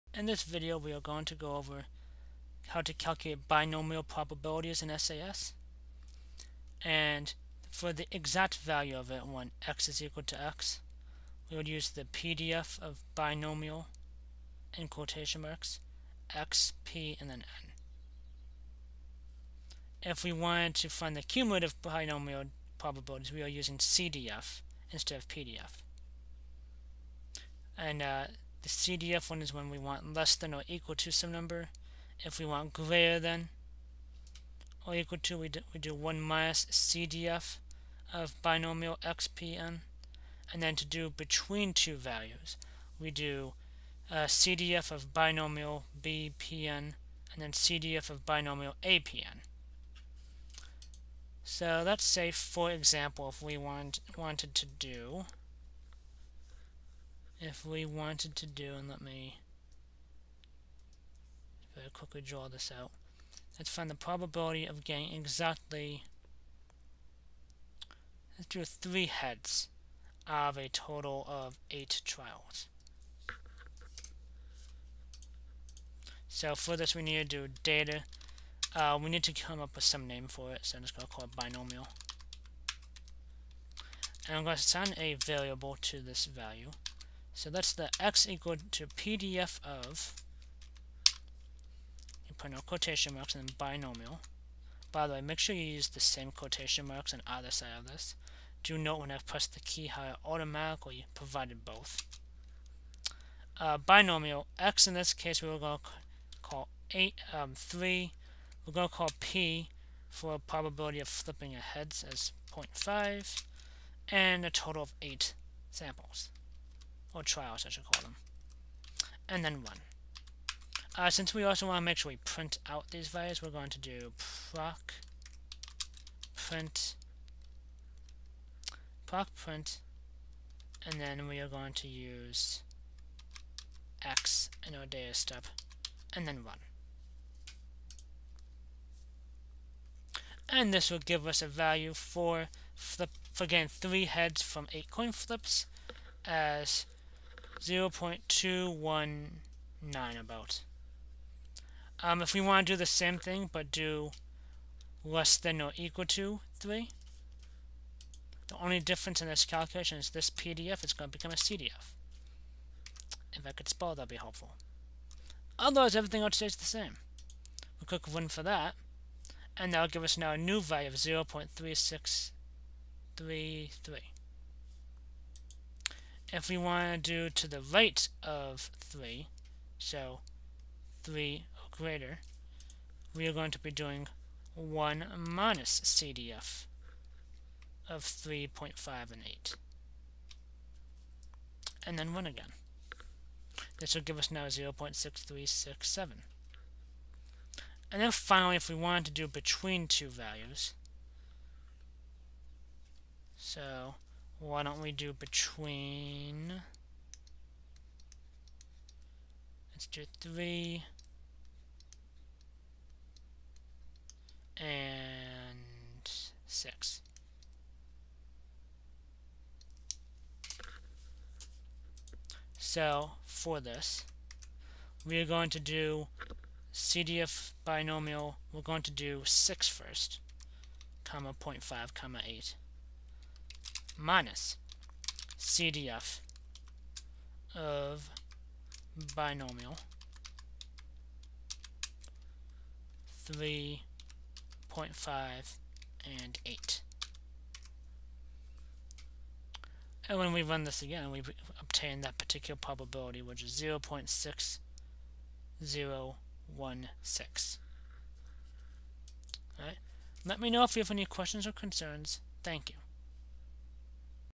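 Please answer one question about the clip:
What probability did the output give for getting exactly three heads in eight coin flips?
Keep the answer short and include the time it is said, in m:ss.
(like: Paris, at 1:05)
0.219, at 2:27.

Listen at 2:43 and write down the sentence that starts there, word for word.
If I could spell, that'd be helpful.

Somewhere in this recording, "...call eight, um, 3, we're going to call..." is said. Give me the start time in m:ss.
1:46.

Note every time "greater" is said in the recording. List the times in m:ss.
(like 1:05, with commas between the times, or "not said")
0:32, 3:01.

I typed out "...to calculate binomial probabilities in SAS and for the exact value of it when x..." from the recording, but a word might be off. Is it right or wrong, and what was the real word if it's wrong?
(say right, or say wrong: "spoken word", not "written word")
right.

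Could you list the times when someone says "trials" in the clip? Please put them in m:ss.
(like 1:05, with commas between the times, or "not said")
1:12, 1:57.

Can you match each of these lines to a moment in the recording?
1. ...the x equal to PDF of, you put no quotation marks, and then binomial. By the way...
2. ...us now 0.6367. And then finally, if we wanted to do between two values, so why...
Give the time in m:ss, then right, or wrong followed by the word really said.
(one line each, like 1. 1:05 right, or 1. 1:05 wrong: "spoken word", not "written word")
1. 1:27 right
2. 3:14 right.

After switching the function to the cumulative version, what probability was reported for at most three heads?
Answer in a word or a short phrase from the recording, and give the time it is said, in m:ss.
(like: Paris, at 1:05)
0.3633, at 2:50.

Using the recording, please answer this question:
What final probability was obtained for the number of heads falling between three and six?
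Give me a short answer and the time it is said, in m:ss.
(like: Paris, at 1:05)
0.6016, at 4:13.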